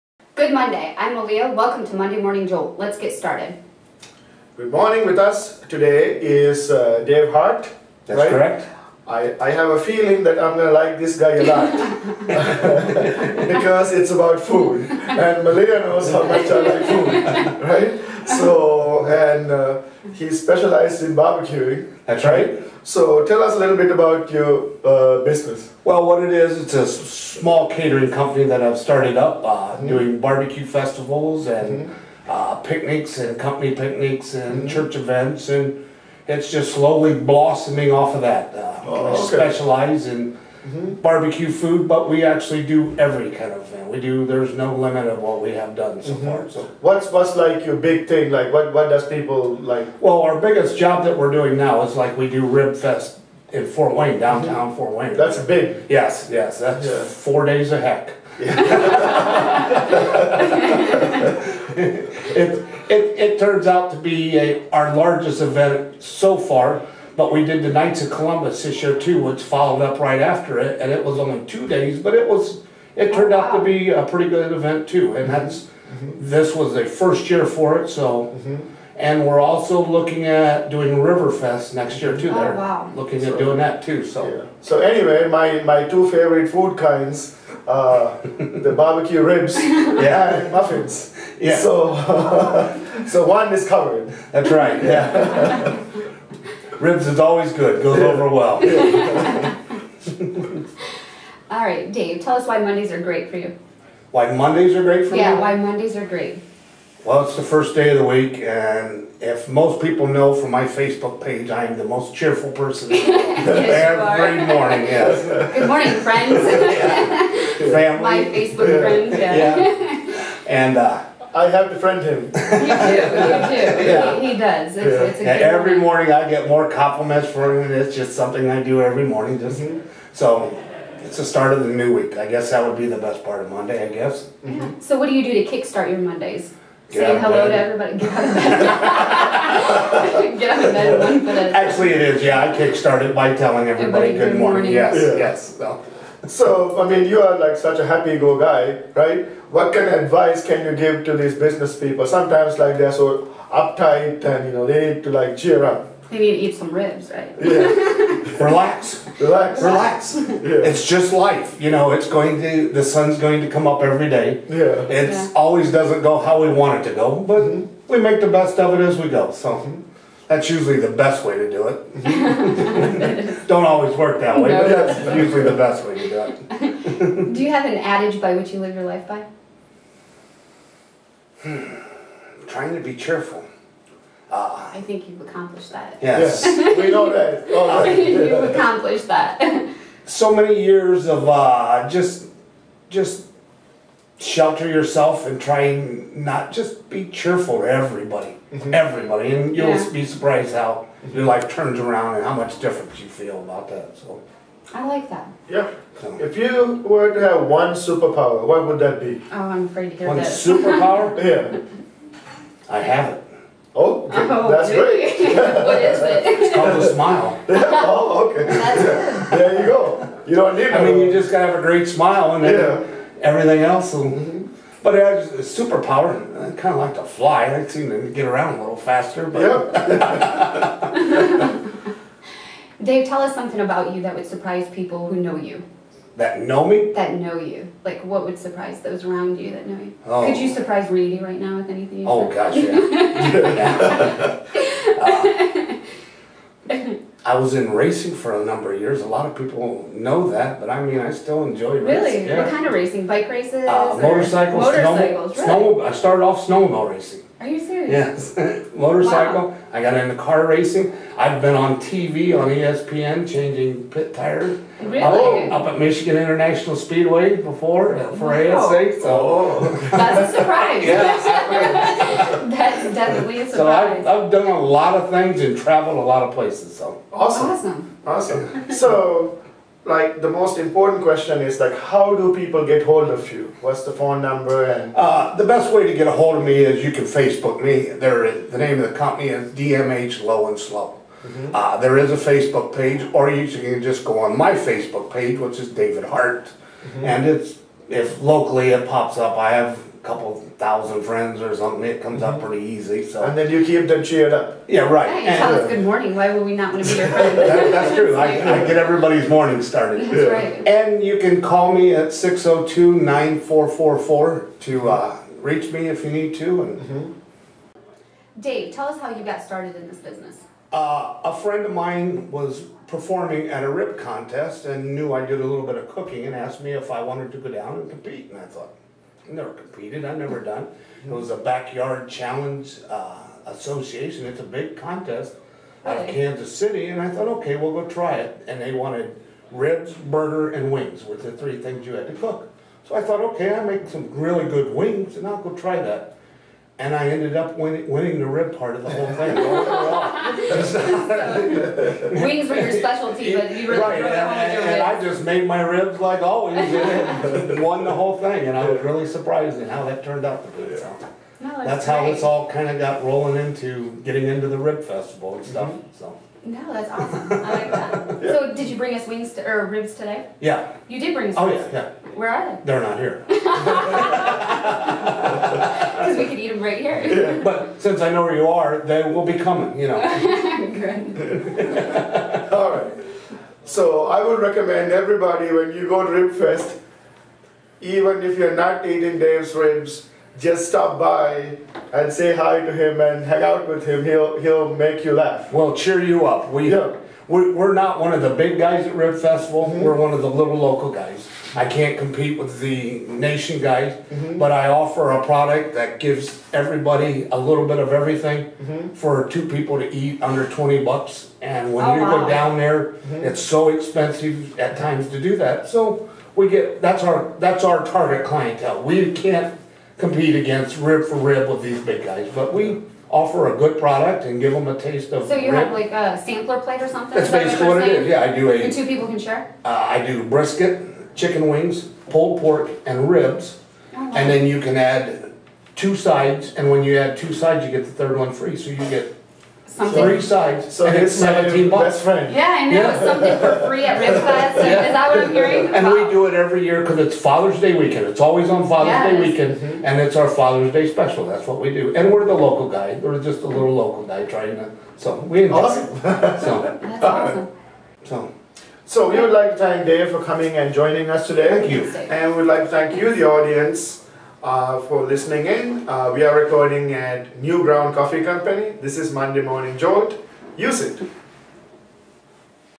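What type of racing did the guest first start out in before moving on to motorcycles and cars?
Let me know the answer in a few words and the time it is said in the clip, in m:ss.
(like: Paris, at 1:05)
Snowmobile racing, at 4:16.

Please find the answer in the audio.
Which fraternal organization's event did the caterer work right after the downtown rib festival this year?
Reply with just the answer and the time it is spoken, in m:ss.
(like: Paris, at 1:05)
Knights of Columbus, at 1:07.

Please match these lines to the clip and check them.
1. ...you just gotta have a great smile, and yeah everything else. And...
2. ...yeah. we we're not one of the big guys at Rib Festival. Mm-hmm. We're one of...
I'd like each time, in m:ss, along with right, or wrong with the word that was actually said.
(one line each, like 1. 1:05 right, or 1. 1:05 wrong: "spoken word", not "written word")
1. 3:40 right
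2. 6:36 right.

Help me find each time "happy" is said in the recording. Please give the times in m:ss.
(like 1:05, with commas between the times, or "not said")
2:27.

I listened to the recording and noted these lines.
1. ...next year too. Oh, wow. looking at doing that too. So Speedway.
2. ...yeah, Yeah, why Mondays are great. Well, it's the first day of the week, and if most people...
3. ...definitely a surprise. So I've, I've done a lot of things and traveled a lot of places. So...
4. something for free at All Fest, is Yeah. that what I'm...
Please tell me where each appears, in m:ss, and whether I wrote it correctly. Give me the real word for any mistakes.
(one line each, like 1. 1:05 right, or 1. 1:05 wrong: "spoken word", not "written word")
1. 1:21 wrong: "Yeah", not "Speedway"
2. 1:45 right
3. 4:32 right
4. 7:22 wrong: "Rib", not "All".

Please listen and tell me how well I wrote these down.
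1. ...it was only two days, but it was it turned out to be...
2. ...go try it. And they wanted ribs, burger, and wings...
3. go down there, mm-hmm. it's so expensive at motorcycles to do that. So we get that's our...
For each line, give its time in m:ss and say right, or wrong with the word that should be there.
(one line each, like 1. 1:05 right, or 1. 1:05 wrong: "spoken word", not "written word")
1. 1:10 right
2. 5:37 right
3. 6:52 wrong: "times", not "motorcycles".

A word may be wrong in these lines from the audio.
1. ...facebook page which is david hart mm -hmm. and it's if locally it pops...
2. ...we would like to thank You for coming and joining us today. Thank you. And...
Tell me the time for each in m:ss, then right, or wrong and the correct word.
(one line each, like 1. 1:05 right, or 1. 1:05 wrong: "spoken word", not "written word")
1. 4:54 right
2. 7:39 wrong: "Dave", not "You".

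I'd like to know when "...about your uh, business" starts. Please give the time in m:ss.
0:23.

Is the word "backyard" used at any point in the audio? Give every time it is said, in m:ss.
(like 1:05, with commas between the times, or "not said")
5:31.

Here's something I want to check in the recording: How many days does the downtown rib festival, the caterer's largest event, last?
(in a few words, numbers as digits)
4 days.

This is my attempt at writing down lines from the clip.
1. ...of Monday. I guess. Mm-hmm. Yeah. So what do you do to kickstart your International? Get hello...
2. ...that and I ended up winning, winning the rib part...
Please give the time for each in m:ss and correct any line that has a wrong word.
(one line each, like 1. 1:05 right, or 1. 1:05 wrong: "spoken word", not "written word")
1. 2:13 wrong: "Mondays", not "International"
2. 5:45 right.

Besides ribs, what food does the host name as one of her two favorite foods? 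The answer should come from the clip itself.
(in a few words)
Muffins.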